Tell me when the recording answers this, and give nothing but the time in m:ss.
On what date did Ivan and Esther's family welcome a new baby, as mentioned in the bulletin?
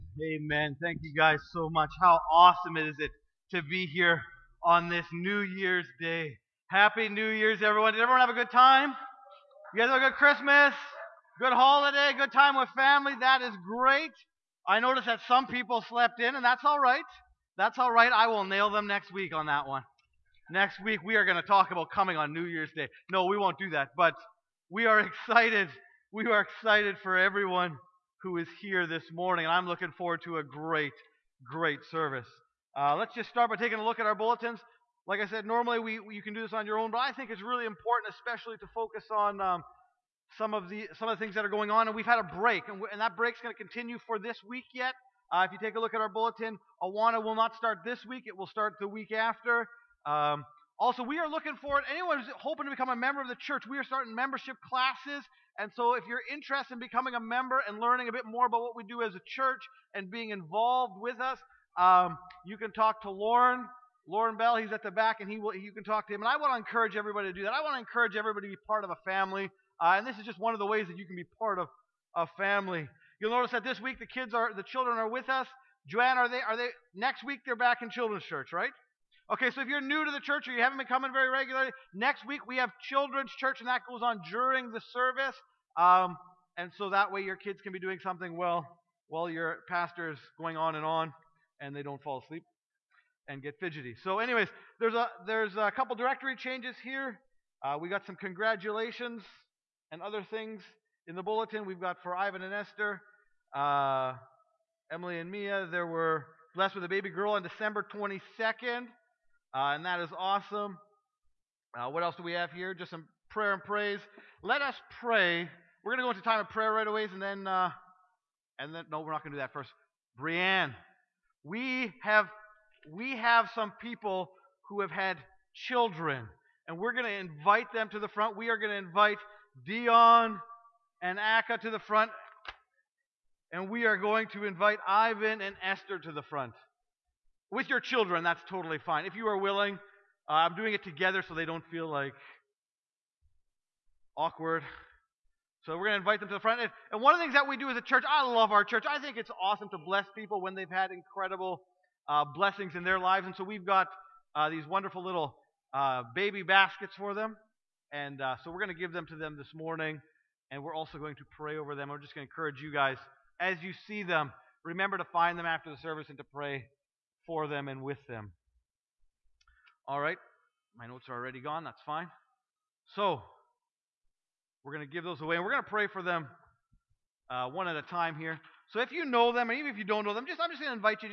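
1:47.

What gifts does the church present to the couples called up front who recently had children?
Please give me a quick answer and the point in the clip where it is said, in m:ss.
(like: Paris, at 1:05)
baby baskets, at 2:36.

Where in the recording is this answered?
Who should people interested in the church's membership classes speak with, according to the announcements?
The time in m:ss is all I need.
1:03.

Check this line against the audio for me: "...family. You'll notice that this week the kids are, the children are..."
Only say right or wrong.
right.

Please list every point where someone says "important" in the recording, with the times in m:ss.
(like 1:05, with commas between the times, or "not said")
0:37.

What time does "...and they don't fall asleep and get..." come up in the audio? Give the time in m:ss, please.
1:31.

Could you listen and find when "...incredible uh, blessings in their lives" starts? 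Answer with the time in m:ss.
2:30.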